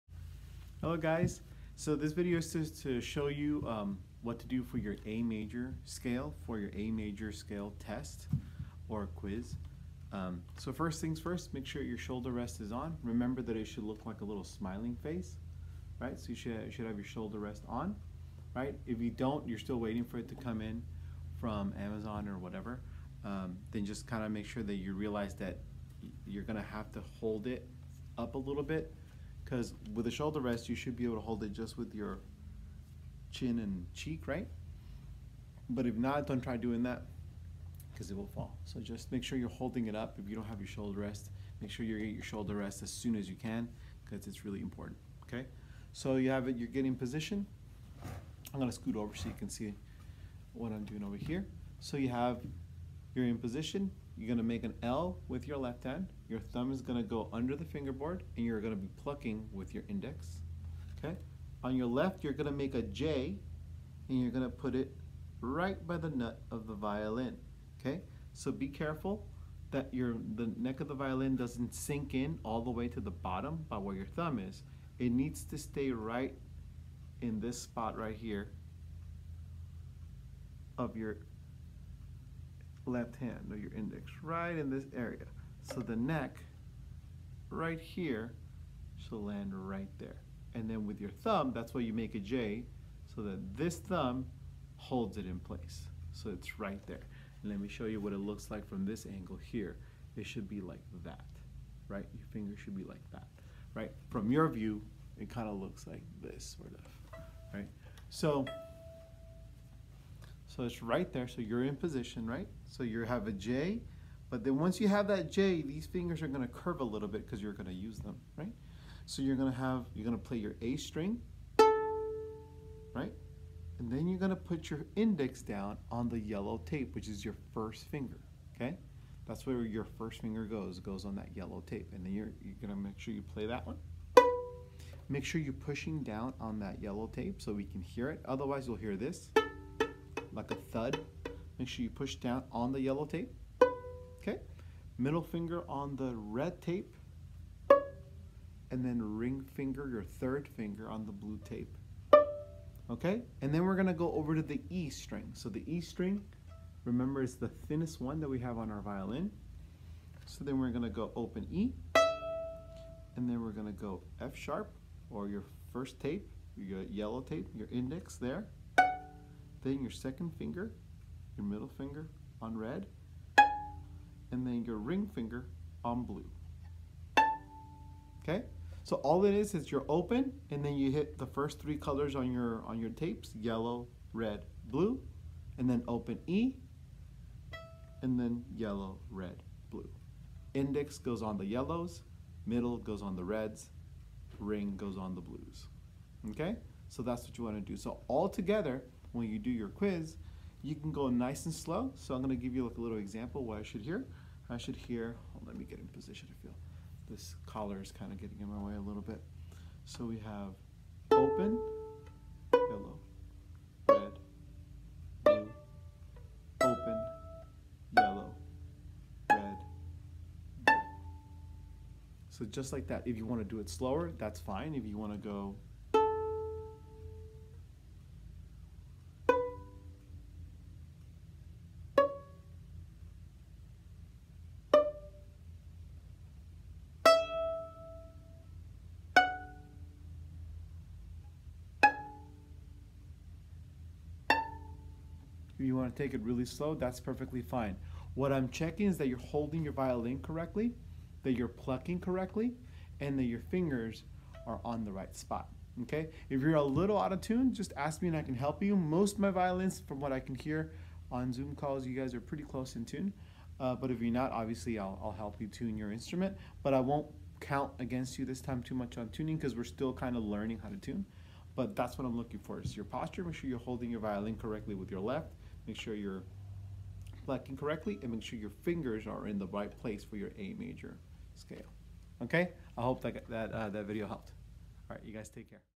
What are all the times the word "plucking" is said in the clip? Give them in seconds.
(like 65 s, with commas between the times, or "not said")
59 s, 251 s, 277 s.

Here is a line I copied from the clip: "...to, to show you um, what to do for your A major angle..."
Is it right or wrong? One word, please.
wrong.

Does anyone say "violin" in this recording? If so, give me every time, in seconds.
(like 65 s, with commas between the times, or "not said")
66 s, 70 s, 158 s, 249 s, 259 s, 273 s.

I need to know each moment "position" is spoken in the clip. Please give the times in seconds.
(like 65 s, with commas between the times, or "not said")
46 s, 53 s, 111 s, 205 s.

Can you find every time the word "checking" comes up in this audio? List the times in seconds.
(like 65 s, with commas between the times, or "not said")
248 s.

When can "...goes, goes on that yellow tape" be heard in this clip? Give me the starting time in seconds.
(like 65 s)
130 s.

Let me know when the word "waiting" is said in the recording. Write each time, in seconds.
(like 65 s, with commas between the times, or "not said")
19 s.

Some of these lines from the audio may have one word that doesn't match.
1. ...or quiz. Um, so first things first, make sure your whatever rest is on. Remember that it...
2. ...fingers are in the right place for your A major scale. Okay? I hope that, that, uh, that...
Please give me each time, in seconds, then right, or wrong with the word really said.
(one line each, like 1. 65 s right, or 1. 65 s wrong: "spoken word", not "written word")
1. 8 s wrong: "shoulder", not "whatever"
2. 278 s right.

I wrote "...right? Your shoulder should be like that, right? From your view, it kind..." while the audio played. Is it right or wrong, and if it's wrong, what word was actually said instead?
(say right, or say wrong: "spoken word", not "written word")
wrong: "finger", not "shoulder".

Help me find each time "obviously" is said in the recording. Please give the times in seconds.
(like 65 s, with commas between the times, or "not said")
264 s.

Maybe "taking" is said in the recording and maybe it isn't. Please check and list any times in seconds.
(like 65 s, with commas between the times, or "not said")
not said.